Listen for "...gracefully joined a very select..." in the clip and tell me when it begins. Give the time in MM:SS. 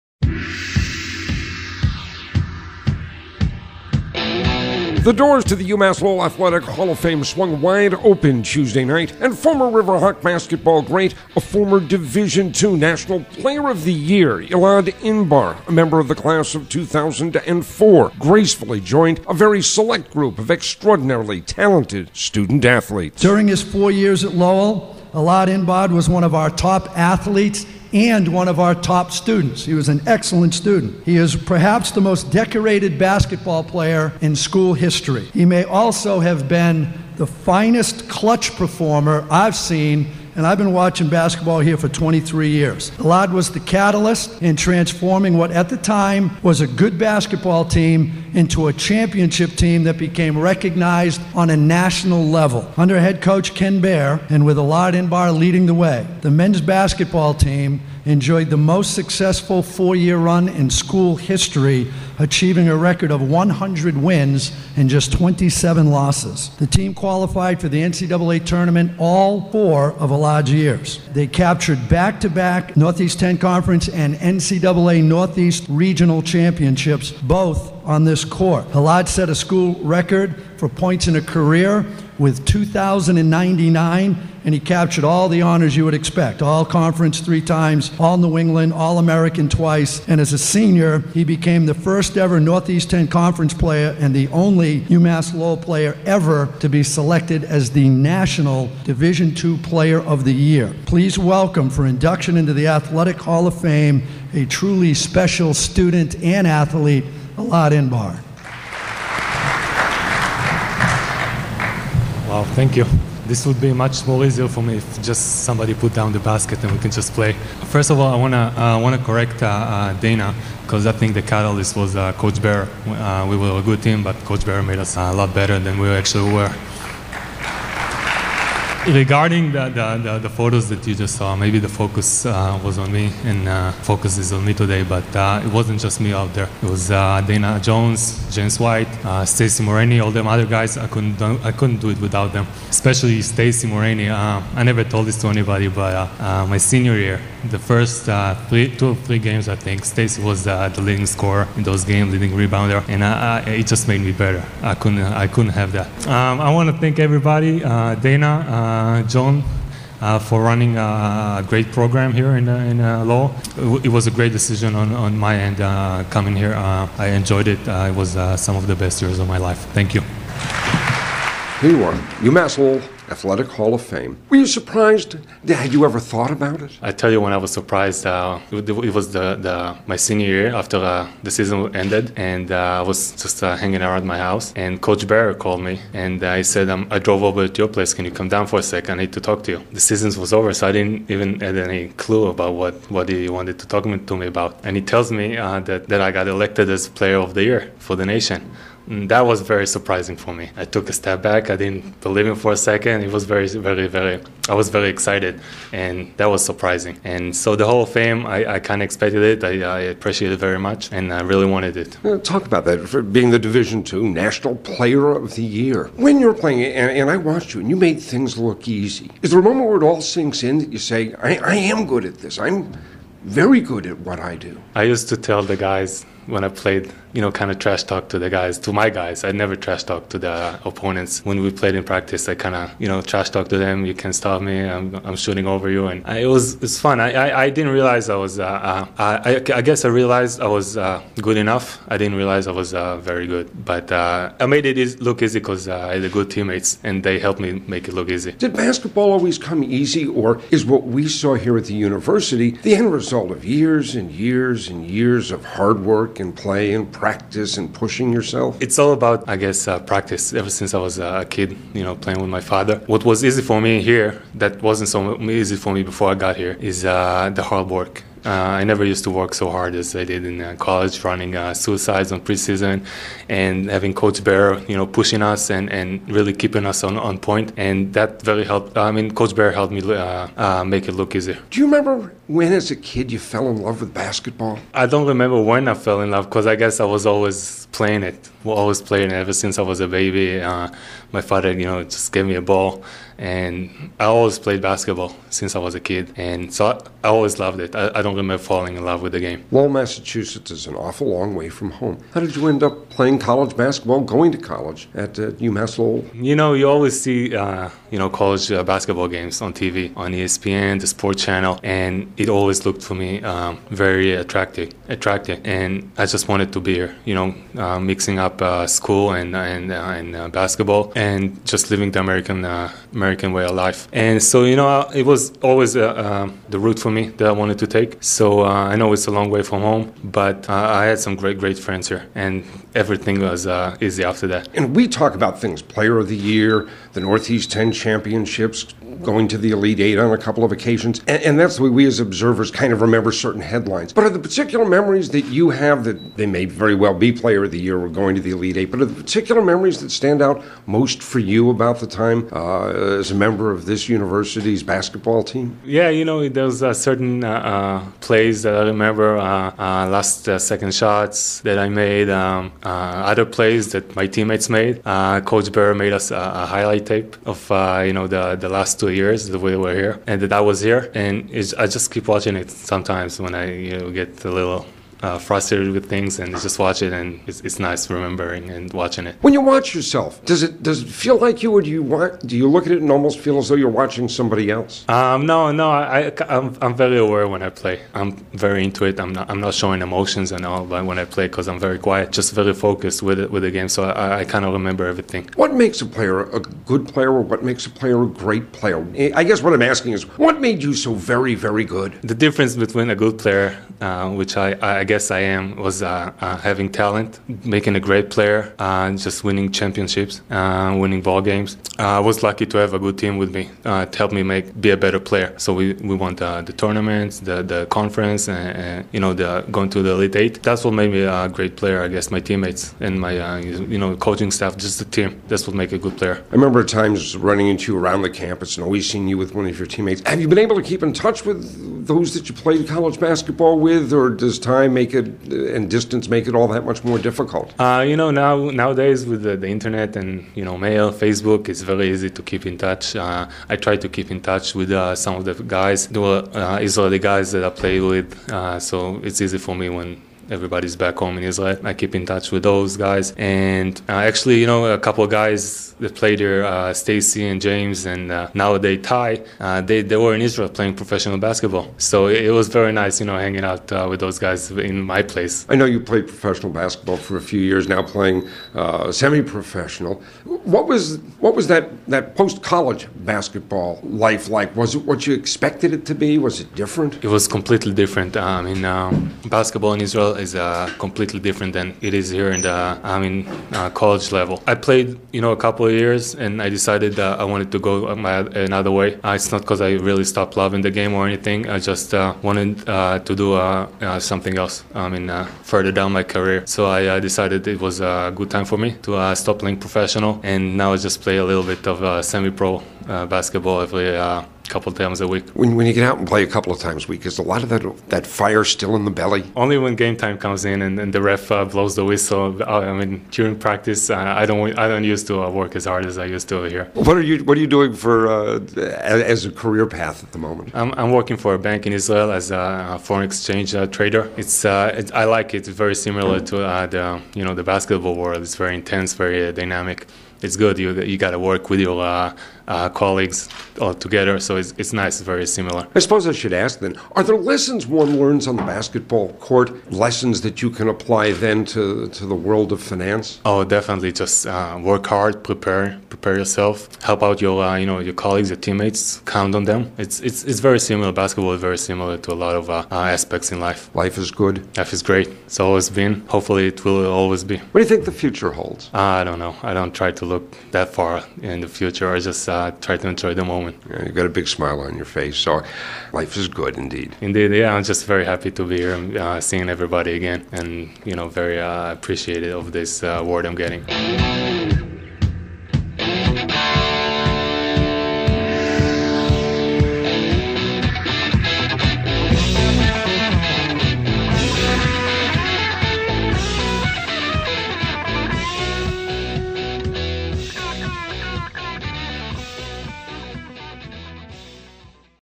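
00:18.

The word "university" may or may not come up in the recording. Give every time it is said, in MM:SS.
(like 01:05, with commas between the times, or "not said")
04:11, 05:53.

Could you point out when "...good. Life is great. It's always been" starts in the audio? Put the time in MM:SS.
09:14.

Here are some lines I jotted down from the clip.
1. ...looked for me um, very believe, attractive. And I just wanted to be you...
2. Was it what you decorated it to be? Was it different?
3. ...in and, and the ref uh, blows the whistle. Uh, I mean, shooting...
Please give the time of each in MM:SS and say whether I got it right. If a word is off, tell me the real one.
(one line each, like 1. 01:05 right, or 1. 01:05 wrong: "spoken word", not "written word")
1. 05:12 wrong: "attractive", not "believe"
2. 07:54 wrong: "expected", not "decorated"
3. 08:30 wrong: "during", not "shooting".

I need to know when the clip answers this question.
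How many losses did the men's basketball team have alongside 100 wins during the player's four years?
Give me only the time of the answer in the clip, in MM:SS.
01:05.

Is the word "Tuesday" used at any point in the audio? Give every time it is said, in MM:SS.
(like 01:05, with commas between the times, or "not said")
00:08.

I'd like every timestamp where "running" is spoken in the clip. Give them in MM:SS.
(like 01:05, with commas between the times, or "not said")
02:40, 04:31, 07:07.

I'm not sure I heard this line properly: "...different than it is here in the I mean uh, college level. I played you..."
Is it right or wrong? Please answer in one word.
right.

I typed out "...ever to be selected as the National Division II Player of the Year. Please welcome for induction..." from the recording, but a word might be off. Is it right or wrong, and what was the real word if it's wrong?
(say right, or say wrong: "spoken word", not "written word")
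right.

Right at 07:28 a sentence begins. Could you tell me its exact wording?
Uh, so it's easy for me when everybody's back home in Israel.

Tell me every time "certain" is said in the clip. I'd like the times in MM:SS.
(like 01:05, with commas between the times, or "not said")
05:43, 05:56.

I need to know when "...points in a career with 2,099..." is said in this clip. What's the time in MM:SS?
01:20.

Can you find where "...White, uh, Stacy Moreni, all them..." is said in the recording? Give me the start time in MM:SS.
02:18.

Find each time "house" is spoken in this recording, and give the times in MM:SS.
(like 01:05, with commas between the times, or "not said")
03:04.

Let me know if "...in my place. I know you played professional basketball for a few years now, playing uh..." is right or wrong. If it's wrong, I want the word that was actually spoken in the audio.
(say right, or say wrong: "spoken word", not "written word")
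right.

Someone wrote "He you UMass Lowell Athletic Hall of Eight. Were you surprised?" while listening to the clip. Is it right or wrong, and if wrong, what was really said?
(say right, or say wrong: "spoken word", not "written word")
wrong: "Fame", not "Eight".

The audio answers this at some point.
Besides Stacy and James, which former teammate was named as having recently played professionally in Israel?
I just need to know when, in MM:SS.
07:38.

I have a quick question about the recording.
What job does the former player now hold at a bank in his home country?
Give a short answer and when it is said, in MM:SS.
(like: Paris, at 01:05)
foreign exchange trader, at 08:42.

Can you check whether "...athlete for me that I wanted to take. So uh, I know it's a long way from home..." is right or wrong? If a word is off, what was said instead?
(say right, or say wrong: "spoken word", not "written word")
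wrong: "route", not "athlete".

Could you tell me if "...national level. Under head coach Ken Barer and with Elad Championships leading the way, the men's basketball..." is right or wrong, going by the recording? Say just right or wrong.
wrong.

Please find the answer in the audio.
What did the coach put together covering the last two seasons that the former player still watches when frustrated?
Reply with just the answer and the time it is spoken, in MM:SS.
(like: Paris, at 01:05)
highlight tape, at 06:06.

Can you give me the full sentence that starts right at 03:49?
I never trash talk to the opponents.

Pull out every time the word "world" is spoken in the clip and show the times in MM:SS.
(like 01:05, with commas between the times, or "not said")
08:48, 09:02.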